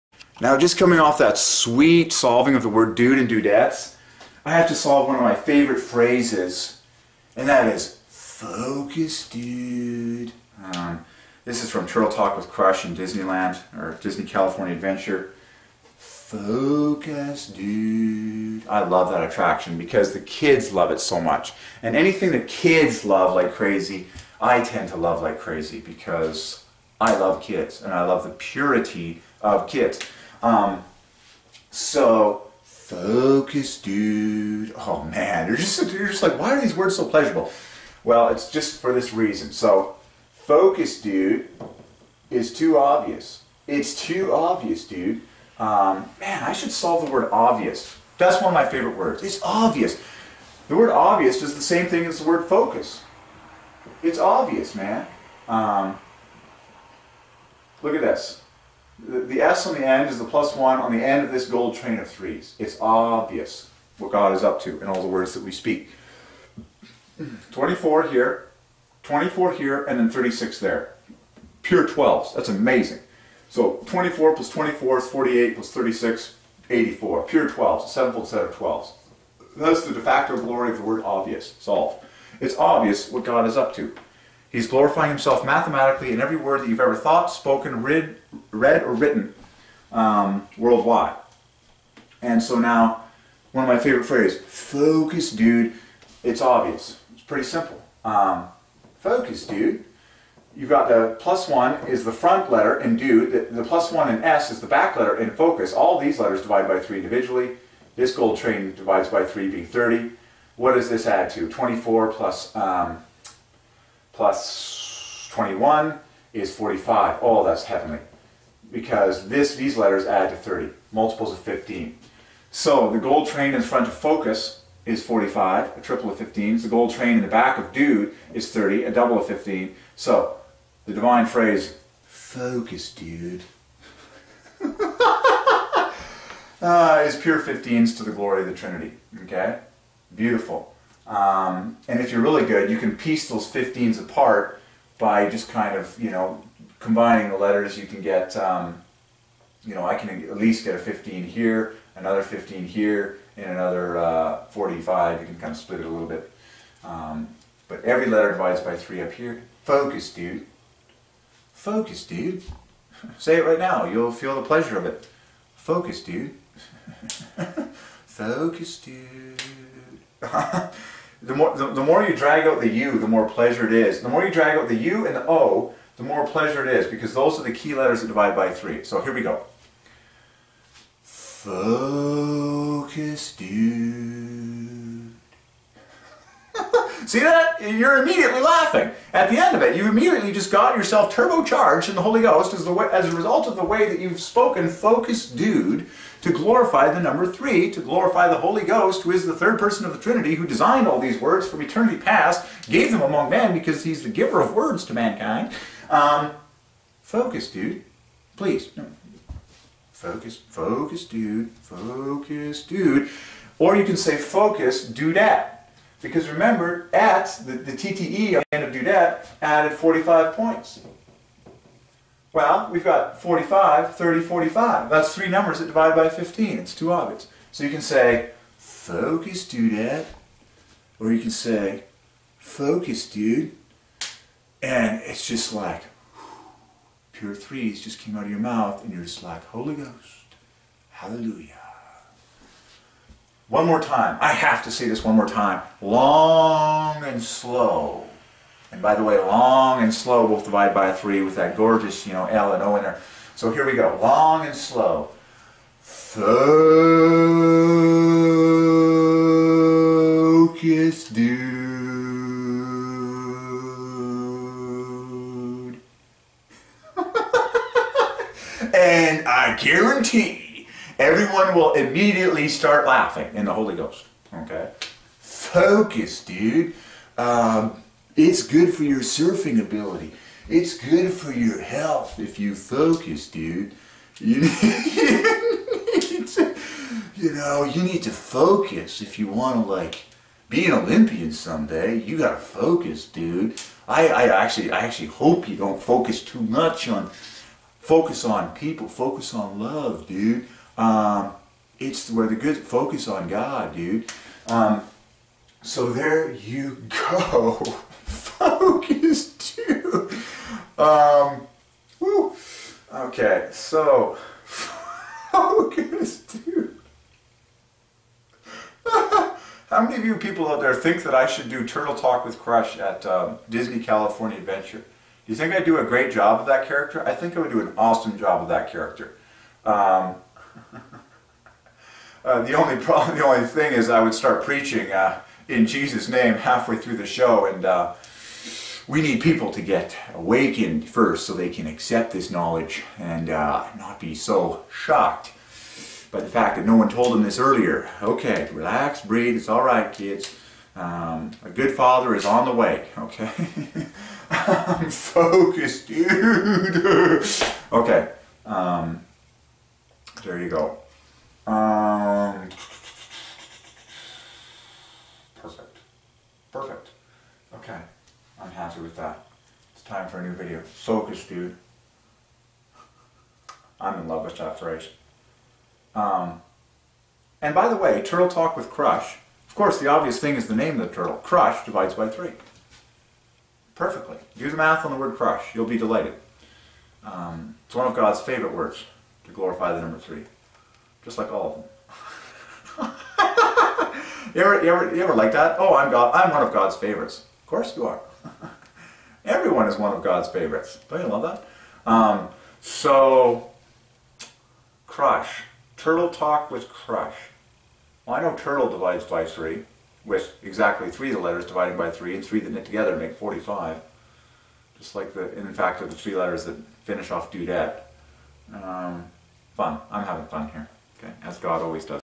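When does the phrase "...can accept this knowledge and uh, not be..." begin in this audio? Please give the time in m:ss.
5:41.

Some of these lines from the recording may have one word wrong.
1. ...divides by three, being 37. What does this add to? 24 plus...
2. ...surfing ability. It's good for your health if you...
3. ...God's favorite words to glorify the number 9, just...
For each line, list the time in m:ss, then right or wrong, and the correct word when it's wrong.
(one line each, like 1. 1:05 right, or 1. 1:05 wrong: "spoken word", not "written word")
1. 1:48 wrong: "30", not "37"
2. 4:38 right
3. 6:27 wrong: "3", not "9".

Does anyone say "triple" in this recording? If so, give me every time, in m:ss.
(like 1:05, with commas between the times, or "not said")
2:05.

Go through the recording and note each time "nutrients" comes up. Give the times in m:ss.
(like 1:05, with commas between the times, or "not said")
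not said.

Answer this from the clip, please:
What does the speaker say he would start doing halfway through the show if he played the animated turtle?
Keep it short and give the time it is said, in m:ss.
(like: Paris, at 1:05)
preaching, at 5:34.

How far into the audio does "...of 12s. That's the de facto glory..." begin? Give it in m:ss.
1:18.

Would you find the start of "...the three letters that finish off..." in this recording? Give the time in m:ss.
6:55.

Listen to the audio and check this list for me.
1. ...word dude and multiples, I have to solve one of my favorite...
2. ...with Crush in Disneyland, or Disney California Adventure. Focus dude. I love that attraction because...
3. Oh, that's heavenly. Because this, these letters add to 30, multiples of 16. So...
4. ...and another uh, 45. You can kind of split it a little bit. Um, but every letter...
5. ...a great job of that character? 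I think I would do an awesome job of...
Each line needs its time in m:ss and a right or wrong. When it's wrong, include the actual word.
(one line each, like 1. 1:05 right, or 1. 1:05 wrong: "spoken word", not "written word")
1. 0:02 wrong: "dudettes", not "multiples"
2. 0:12 right
3. 1:57 wrong: "15", not "16"
4. 2:33 right
5. 5:25 right.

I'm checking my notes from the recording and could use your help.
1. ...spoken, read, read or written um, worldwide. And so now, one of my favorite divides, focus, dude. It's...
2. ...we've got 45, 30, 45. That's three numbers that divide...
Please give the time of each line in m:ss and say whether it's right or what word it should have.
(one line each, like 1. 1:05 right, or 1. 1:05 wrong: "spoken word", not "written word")
1. 1:27 wrong: "phrases", not "divides"
2. 3:42 right.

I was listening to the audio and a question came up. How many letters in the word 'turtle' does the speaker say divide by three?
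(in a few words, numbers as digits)
3.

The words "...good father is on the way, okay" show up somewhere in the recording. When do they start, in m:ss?
5:51.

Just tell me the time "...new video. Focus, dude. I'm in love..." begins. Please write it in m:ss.
6:10.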